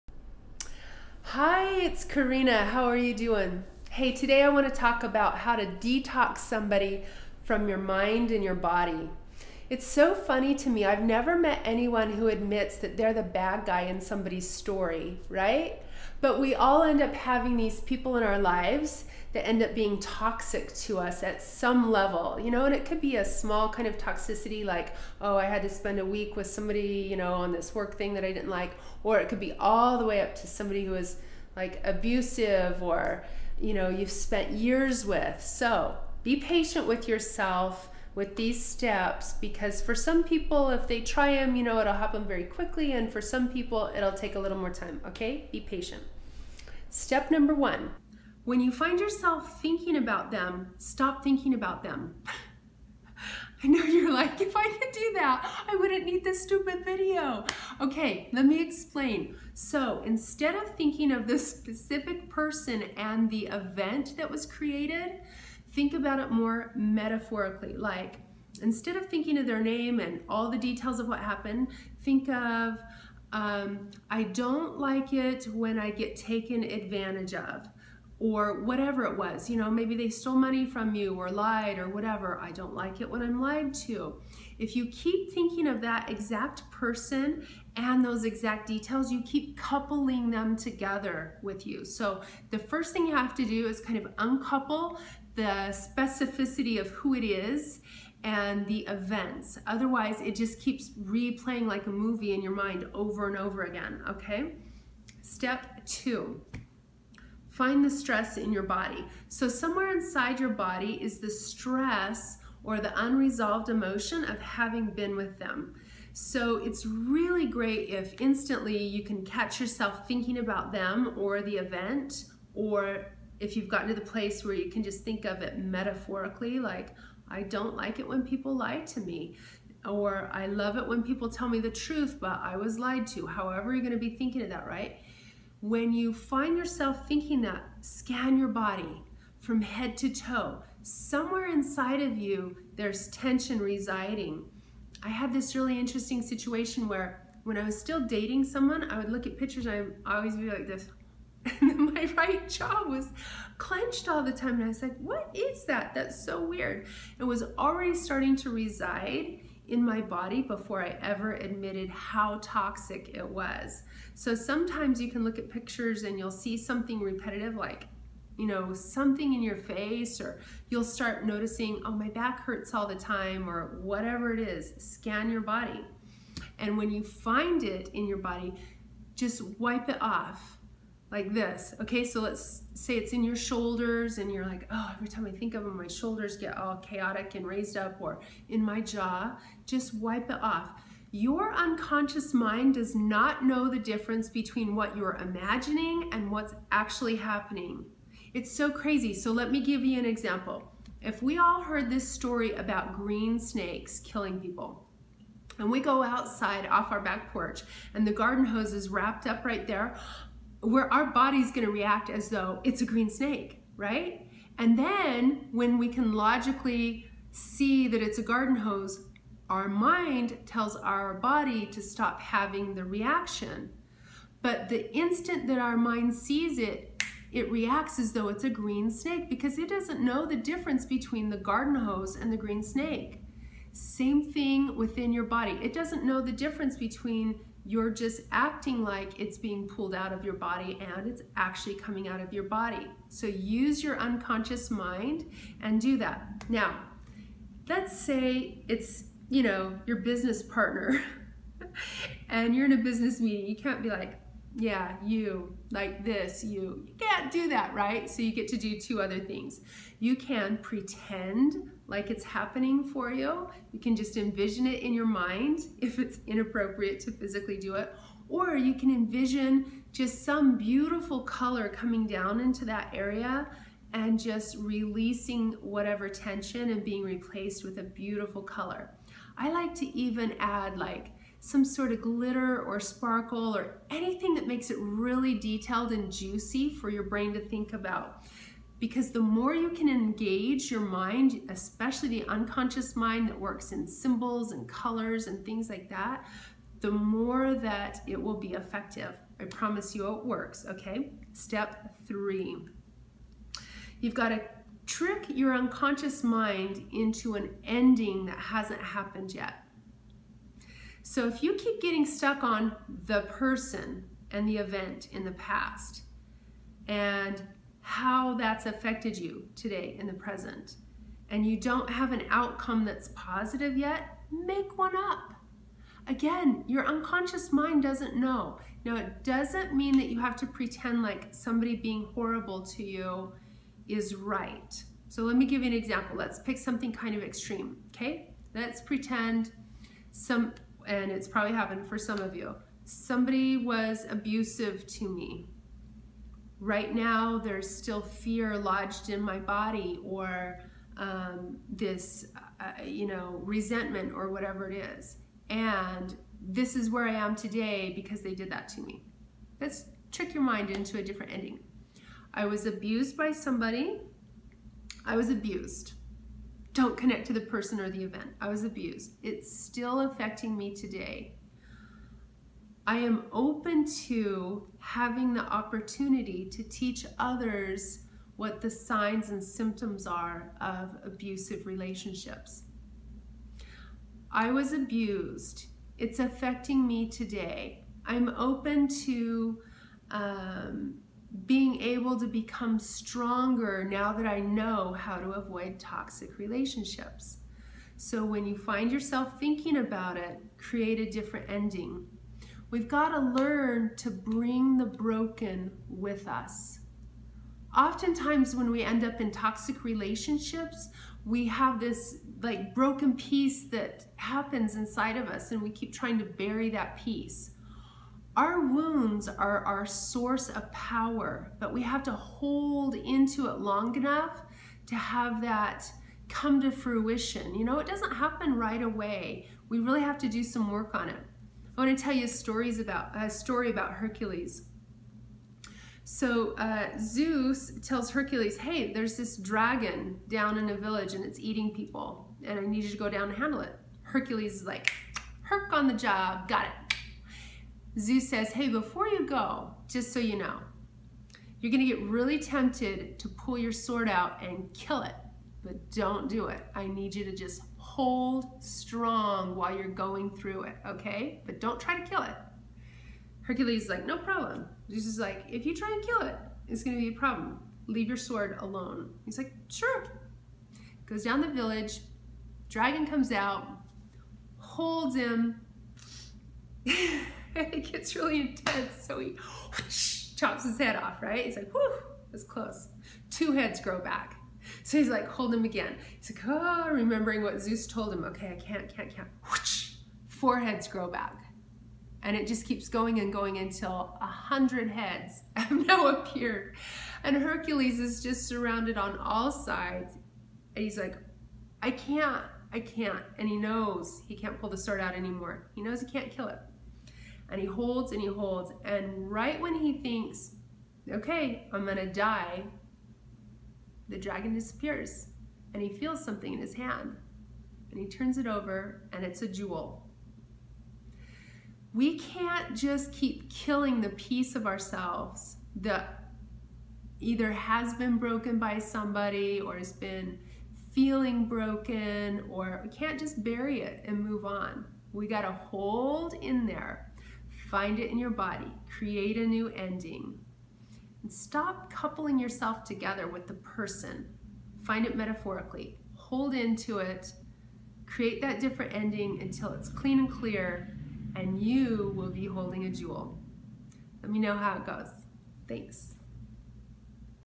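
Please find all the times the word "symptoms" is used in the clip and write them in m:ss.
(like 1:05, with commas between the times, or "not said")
6:19.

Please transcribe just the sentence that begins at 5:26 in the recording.
Again, your unconscious mind doesn't know.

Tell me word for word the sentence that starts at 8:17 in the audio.
And Hercules is just surrounded on all sides.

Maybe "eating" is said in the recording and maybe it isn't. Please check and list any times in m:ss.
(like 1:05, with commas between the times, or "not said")
7:21.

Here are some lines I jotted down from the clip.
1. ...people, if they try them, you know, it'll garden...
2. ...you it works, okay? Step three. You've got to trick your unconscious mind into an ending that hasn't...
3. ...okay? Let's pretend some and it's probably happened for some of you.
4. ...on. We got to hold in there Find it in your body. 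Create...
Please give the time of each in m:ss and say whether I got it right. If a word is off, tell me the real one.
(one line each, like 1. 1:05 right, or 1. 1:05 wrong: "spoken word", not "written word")
1. 0:40 wrong: "happen", not "garden"
2. 4:59 right
3. 5:37 right
4. 8:54 right.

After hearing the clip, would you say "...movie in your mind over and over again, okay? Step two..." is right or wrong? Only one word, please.
right.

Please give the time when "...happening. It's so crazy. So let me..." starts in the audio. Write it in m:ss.
3:17.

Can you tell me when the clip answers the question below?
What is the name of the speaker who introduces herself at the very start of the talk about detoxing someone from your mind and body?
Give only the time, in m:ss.
0:02.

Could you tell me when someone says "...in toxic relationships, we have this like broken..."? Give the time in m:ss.
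6:49.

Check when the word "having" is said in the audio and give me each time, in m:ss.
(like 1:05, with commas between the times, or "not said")
0:17, 1:54, 3:42, 6:14.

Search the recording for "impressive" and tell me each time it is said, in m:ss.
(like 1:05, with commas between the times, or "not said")
not said.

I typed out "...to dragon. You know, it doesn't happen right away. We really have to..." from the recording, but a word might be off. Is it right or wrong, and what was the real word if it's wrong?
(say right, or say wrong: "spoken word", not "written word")
wrong: "fruition", not "dragon".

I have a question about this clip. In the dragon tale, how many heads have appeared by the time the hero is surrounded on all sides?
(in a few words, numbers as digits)
100.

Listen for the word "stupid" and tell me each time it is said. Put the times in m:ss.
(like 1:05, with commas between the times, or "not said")
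0:56.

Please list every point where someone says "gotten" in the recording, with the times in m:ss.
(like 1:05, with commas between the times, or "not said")
2:03.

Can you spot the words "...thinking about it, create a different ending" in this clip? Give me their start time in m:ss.
6:39.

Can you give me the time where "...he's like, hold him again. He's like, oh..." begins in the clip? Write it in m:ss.
8:04.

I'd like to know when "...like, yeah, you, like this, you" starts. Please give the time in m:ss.
4:13.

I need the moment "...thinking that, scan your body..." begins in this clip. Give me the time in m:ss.
2:17.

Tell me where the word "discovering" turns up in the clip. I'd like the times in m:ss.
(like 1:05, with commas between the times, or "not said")
not said.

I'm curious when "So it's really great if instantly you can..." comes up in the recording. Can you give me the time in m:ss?
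1:56.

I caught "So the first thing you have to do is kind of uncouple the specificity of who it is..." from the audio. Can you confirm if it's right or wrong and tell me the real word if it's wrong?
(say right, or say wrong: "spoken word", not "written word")
right.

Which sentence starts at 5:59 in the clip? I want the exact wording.
Let's trick your mind into a different ending.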